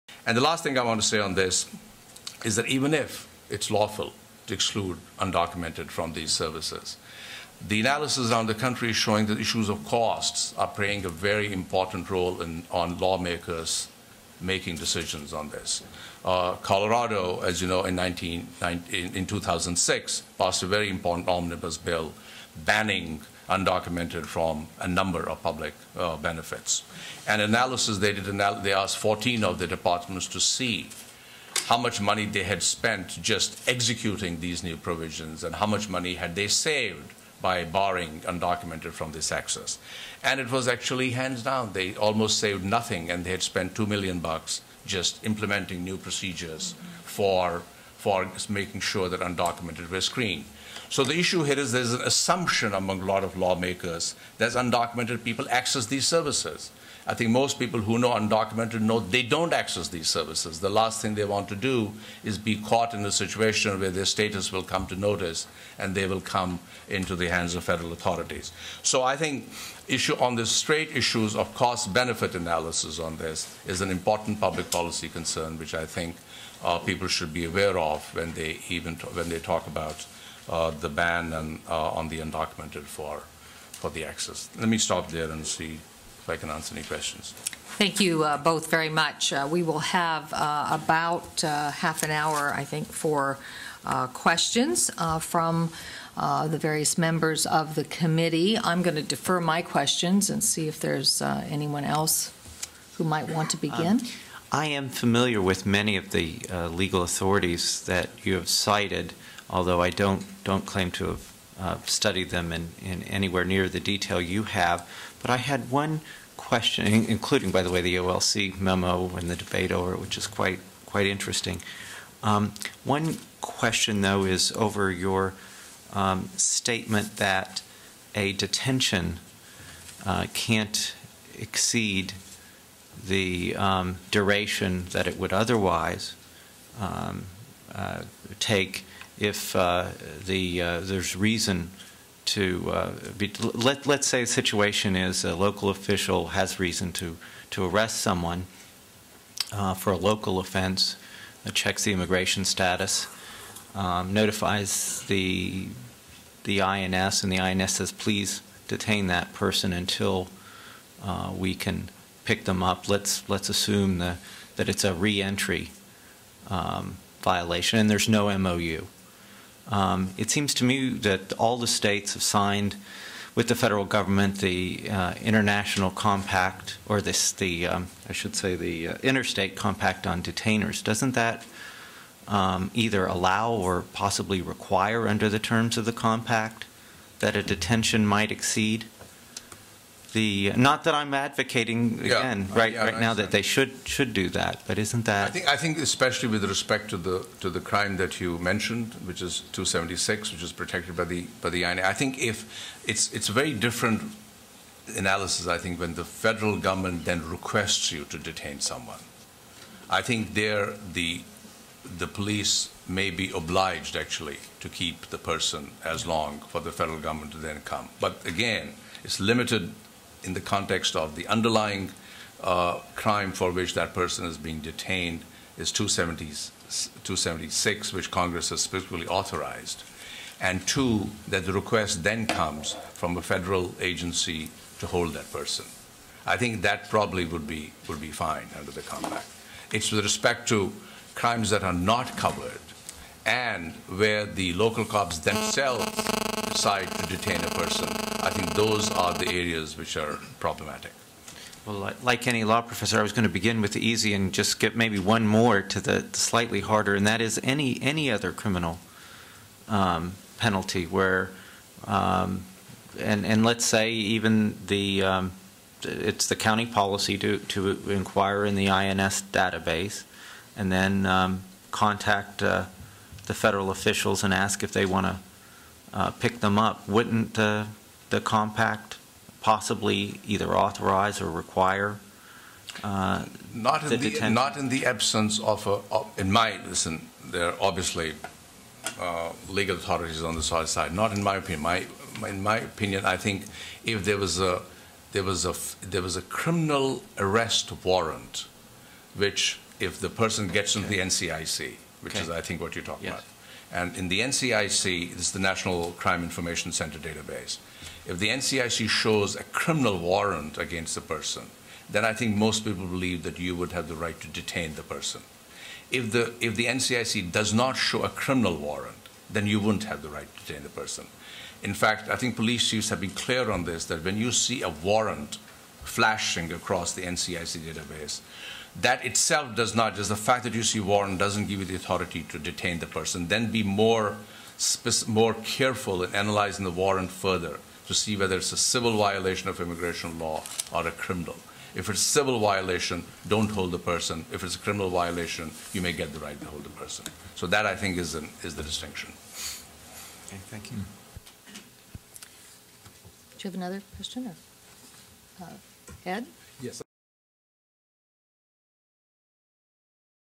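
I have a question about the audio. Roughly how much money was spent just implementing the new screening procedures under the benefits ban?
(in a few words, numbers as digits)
2 million dollars.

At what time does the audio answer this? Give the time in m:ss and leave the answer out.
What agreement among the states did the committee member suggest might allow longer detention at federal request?
2:59.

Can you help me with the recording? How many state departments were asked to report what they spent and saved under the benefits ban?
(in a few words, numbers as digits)
14.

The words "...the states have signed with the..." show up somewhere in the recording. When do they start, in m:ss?
2:51.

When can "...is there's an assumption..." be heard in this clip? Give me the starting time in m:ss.
0:51.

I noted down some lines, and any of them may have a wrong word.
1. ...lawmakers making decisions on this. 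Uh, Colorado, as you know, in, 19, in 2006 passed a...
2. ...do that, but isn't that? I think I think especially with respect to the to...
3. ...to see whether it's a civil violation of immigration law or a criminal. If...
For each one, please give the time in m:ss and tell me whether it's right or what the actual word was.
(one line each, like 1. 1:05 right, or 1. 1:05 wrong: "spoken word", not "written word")
1. 0:12 right
2. 3:14 right
3. 5:37 right.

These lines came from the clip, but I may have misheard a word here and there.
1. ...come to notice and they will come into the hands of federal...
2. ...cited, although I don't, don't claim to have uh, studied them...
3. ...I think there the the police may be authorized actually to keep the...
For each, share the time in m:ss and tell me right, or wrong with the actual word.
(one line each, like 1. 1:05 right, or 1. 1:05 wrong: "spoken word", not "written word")
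1. 1:04 right
2. 1:48 right
3. 3:29 wrong: "obliged", not "authorized".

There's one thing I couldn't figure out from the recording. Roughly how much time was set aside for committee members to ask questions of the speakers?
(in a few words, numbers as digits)
Half an hour.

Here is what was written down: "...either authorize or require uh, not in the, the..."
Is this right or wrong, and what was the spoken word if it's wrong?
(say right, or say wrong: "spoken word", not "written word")
right.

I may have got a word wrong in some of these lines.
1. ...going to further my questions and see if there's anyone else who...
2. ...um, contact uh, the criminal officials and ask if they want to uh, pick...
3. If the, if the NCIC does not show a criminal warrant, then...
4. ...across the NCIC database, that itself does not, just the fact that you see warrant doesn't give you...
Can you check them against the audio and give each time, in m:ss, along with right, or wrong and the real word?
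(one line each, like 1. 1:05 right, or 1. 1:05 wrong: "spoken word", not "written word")
1. 1:38 wrong: "defer", not "further"
2. 4:31 wrong: "federal", not "criminal"
3. 5:15 right
4. 5:26 right.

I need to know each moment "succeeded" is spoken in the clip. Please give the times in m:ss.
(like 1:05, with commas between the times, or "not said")
not said.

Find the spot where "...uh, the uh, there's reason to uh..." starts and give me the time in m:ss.
2:19.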